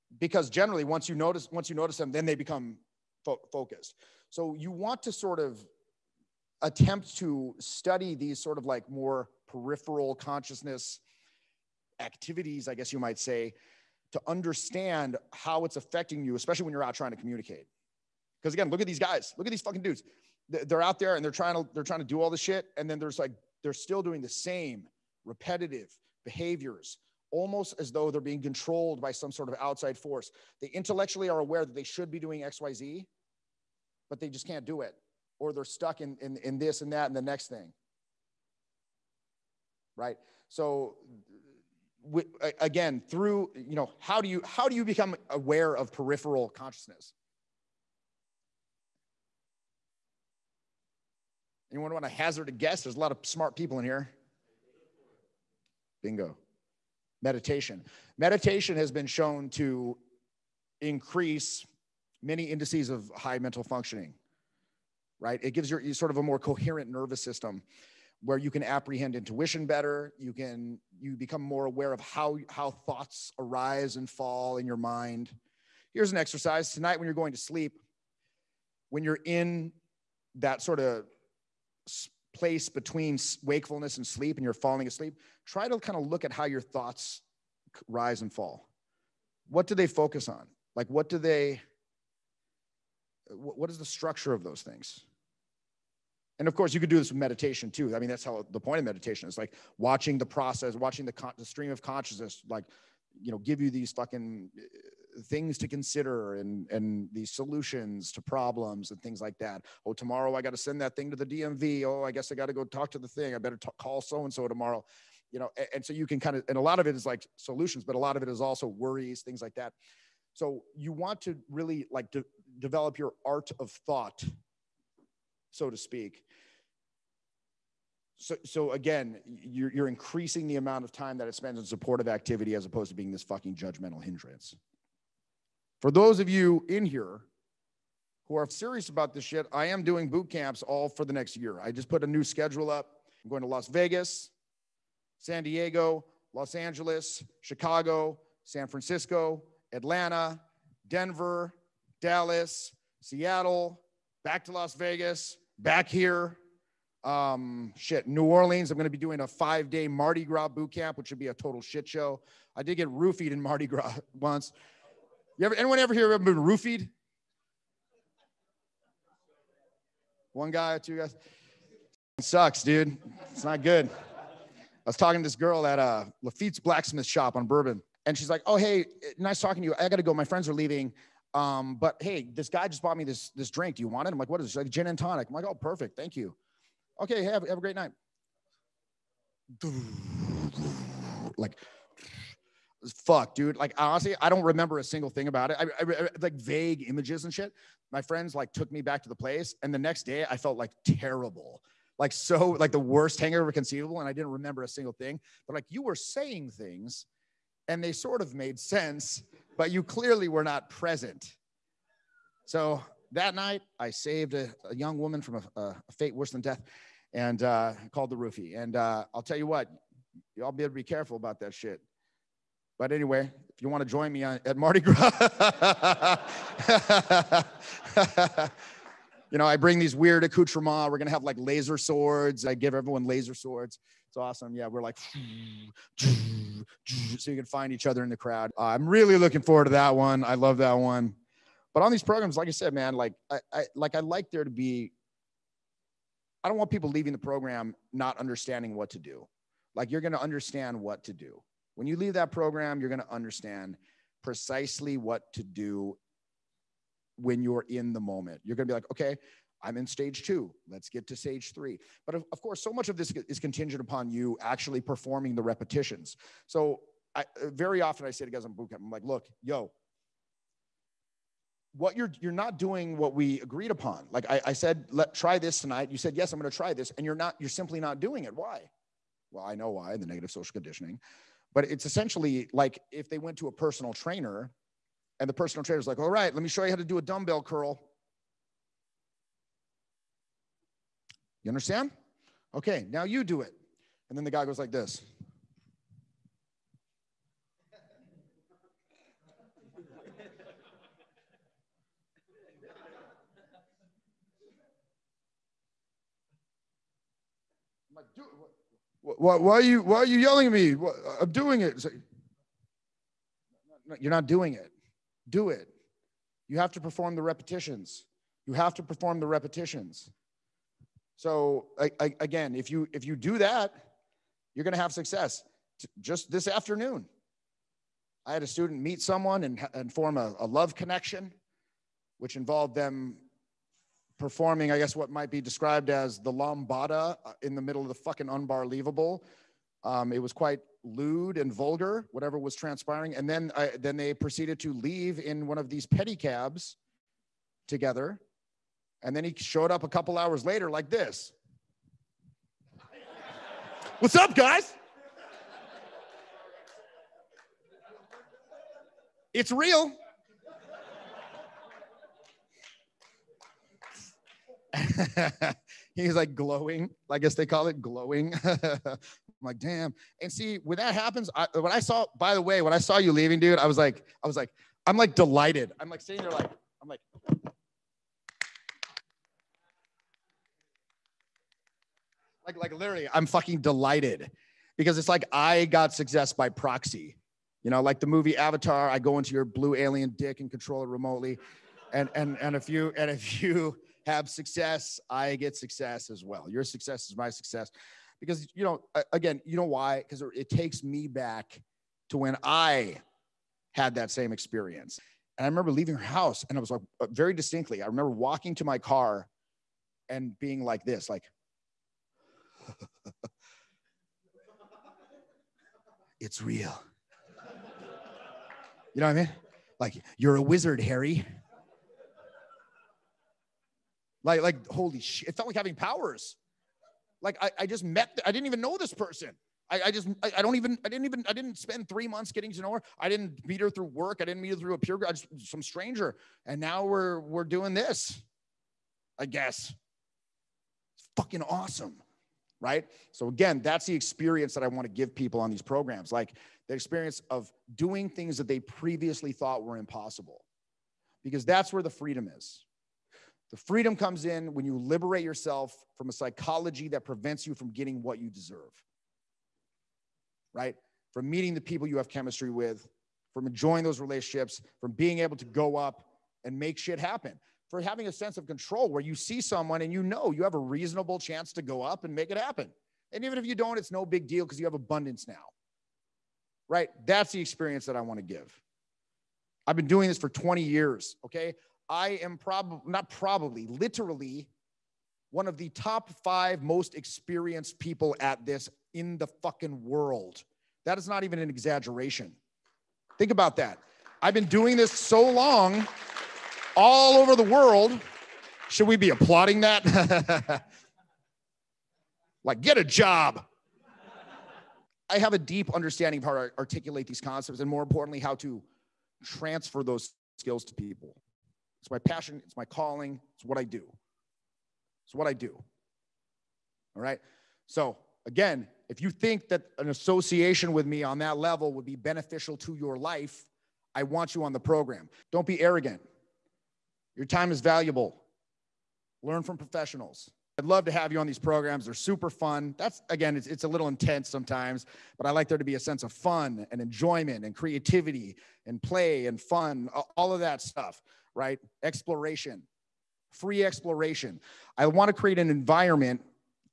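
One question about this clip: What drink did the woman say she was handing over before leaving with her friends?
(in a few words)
Gin and tonic.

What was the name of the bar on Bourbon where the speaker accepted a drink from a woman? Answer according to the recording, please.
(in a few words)
Lafitte's blacksmith shop.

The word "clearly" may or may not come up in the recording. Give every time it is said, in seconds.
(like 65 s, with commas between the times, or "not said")
209 s.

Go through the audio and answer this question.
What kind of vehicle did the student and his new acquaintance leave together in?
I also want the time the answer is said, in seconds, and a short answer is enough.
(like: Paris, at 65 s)
Pedicabs, at 345 s.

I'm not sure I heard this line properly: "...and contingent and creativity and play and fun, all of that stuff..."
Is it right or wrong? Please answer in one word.
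wrong.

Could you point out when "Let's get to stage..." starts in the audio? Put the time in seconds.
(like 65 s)
260 s.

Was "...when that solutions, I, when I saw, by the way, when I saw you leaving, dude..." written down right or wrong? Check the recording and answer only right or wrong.
wrong.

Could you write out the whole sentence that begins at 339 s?
Um, it was quite lewd and vulgar, whatever was transpiring.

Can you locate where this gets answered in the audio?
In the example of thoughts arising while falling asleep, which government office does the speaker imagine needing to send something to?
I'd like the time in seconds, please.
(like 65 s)
111 s.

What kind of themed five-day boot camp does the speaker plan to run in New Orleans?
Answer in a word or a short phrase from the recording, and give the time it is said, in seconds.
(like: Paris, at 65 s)
Mardi Gras boot camp, at 159 s.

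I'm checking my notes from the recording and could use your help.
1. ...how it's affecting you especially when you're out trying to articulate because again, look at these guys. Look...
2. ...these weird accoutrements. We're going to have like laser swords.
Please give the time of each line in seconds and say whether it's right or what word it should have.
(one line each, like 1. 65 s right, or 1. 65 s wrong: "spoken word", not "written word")
1. 15 s wrong: "communicate", not "articulate"
2. 229 s right.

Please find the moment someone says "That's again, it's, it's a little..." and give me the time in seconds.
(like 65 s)
532 s.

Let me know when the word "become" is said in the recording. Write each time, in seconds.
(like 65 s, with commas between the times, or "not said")
2 s, 44 s, 71 s.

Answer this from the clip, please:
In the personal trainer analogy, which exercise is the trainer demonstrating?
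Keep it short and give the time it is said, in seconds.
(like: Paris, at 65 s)
Dumbbell curl, at 287 s.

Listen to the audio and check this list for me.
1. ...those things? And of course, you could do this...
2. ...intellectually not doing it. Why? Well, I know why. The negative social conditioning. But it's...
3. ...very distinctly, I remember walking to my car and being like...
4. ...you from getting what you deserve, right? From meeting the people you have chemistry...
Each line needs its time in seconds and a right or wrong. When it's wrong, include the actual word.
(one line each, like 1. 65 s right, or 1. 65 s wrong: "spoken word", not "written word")
1. 94 s right
2. 277 s wrong: "simply", not "intellectually"
3. 407 s right
4. 457 s right.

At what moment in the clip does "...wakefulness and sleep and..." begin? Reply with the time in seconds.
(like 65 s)
83 s.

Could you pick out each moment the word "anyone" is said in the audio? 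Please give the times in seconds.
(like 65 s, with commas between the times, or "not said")
51 s, 165 s.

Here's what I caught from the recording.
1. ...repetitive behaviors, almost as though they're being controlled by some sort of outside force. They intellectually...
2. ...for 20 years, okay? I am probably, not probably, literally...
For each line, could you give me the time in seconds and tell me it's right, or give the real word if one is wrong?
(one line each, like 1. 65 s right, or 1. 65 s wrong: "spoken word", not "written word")
1. 25 s right
2. 480 s right.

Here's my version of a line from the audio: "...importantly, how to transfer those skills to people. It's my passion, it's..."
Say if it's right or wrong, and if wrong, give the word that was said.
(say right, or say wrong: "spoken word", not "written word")
right.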